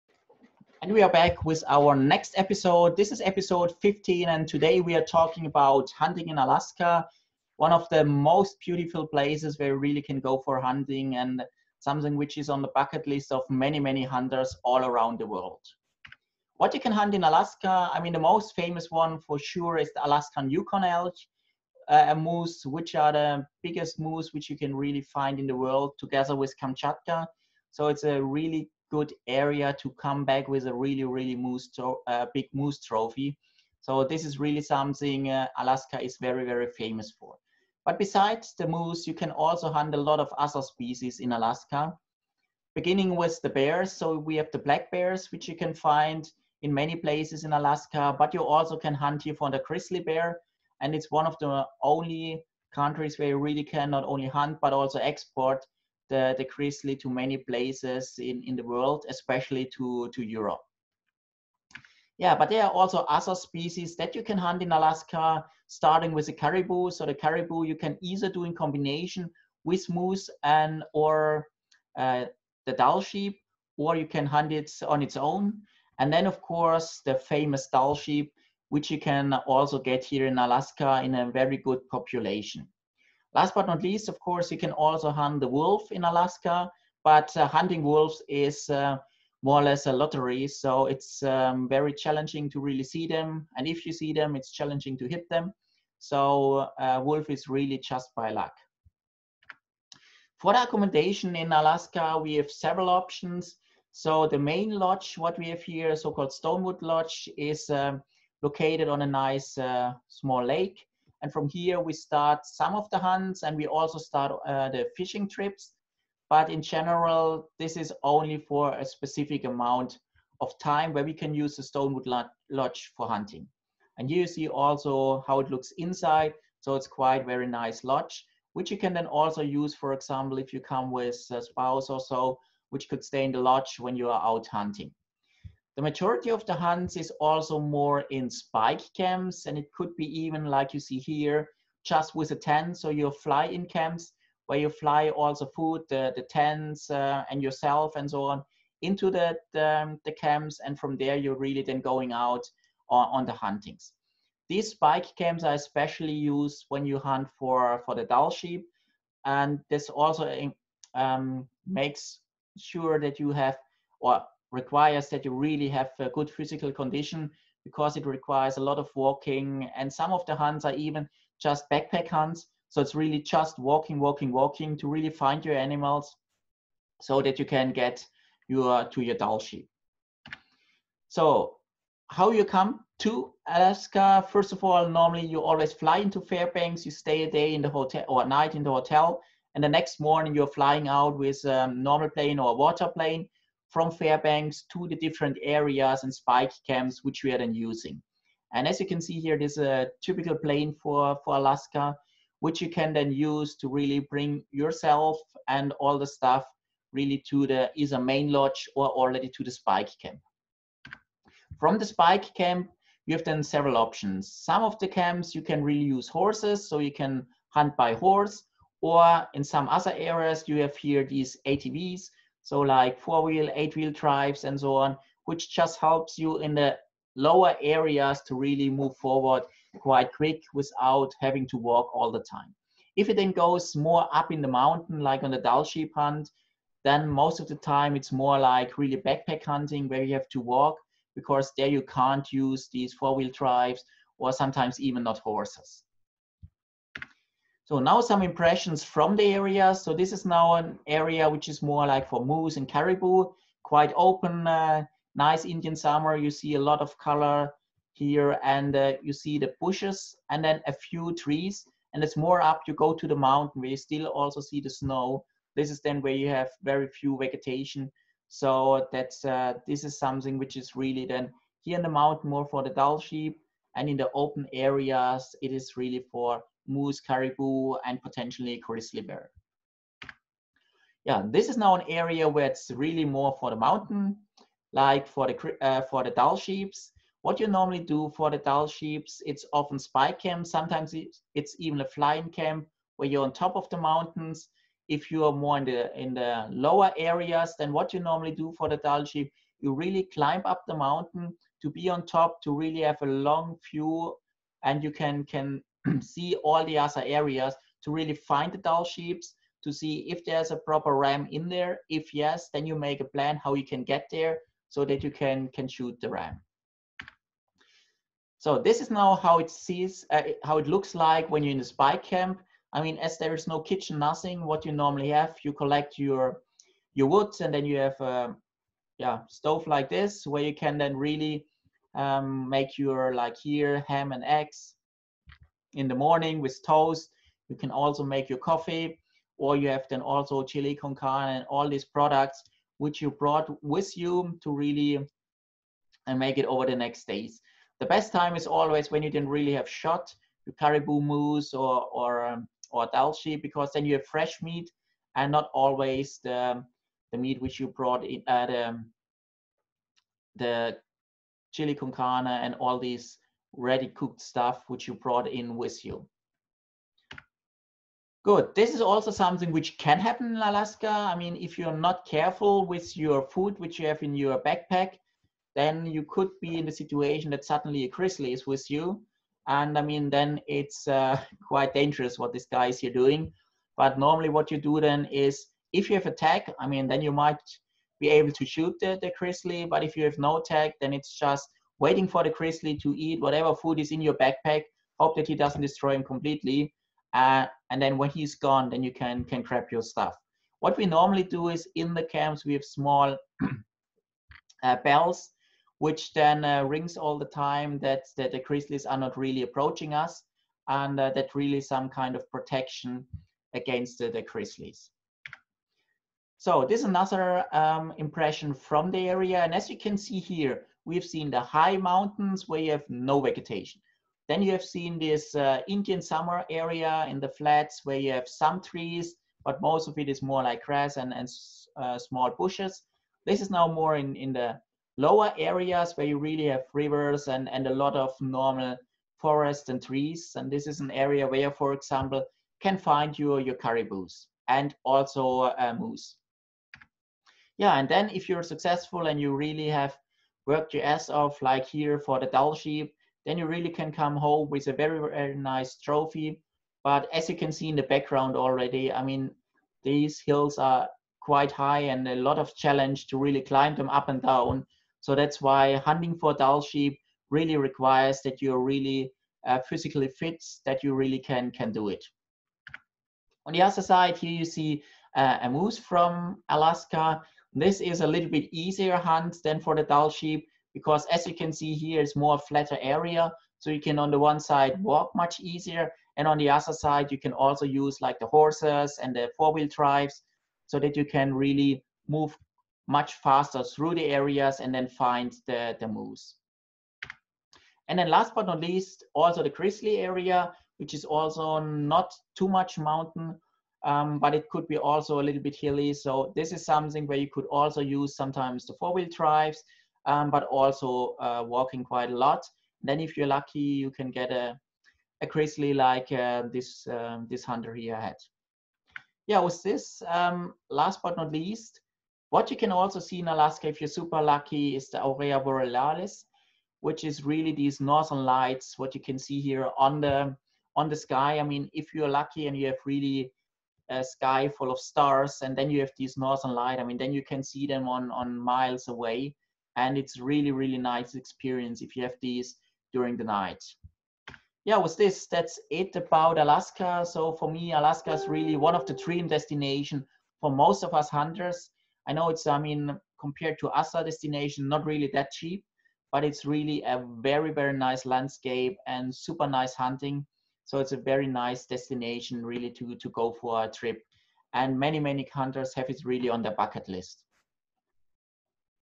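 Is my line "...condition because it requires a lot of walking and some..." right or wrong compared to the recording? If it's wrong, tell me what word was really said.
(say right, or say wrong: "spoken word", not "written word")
right.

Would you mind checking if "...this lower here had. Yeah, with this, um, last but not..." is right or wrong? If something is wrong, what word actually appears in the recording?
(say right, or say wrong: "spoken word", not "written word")
wrong: "hunter", not "lower".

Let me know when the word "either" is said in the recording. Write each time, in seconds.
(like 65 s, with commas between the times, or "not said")
68 s, 207 s.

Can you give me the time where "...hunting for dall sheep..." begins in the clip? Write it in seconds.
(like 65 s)
465 s.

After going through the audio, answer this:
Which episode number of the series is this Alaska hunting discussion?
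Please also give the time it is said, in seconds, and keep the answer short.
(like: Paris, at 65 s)
15, at 3 s.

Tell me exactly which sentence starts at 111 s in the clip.
And from here, we start some of the hunts and we also start uh, the fishing trips.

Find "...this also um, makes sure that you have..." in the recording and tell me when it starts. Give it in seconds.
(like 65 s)
159 s.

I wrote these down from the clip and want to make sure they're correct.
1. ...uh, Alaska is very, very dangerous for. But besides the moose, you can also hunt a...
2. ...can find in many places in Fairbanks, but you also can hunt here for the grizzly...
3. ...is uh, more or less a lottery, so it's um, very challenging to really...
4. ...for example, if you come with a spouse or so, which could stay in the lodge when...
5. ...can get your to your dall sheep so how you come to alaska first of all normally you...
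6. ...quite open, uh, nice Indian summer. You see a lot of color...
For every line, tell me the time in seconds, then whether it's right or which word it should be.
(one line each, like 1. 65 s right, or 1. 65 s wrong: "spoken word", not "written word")
1. 35 s wrong: "famous", not "dangerous"
2. 45 s wrong: "Alaska", not "Fairbanks"
3. 88 s right
4. 129 s right
5. 177 s right
6. 253 s right.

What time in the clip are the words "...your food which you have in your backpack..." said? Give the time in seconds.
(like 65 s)
372 s.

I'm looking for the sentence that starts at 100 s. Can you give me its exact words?
For the accommodation in Alaska, we have several options.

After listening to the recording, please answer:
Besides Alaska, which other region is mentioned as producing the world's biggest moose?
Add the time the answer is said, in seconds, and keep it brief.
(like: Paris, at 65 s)
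Kamchatka, at 26 s.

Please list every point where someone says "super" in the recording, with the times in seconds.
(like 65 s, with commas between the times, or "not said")
523 s, 559 s.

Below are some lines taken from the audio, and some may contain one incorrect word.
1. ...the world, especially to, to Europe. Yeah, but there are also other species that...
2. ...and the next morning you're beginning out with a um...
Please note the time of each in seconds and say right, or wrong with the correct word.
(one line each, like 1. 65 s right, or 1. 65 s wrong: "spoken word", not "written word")
1. 58 s right
2. 189 s wrong: "flying", not "beginning".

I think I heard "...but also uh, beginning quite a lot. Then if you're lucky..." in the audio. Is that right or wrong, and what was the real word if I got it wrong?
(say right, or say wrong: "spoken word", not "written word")
wrong: "walking", not "beginning".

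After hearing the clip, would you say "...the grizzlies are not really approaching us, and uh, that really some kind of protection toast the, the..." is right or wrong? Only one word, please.
wrong.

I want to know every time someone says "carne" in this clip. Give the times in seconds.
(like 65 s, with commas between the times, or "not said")
340 s, 361 s.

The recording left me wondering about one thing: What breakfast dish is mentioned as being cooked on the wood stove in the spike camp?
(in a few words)
ham and eggs.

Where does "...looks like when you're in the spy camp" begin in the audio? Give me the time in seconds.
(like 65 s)
320 s.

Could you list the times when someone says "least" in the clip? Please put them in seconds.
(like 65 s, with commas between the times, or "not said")
83 s, 498 s, 521 s.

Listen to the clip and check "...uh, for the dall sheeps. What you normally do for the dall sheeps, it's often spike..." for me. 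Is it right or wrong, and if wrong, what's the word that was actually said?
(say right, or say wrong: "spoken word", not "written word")
right.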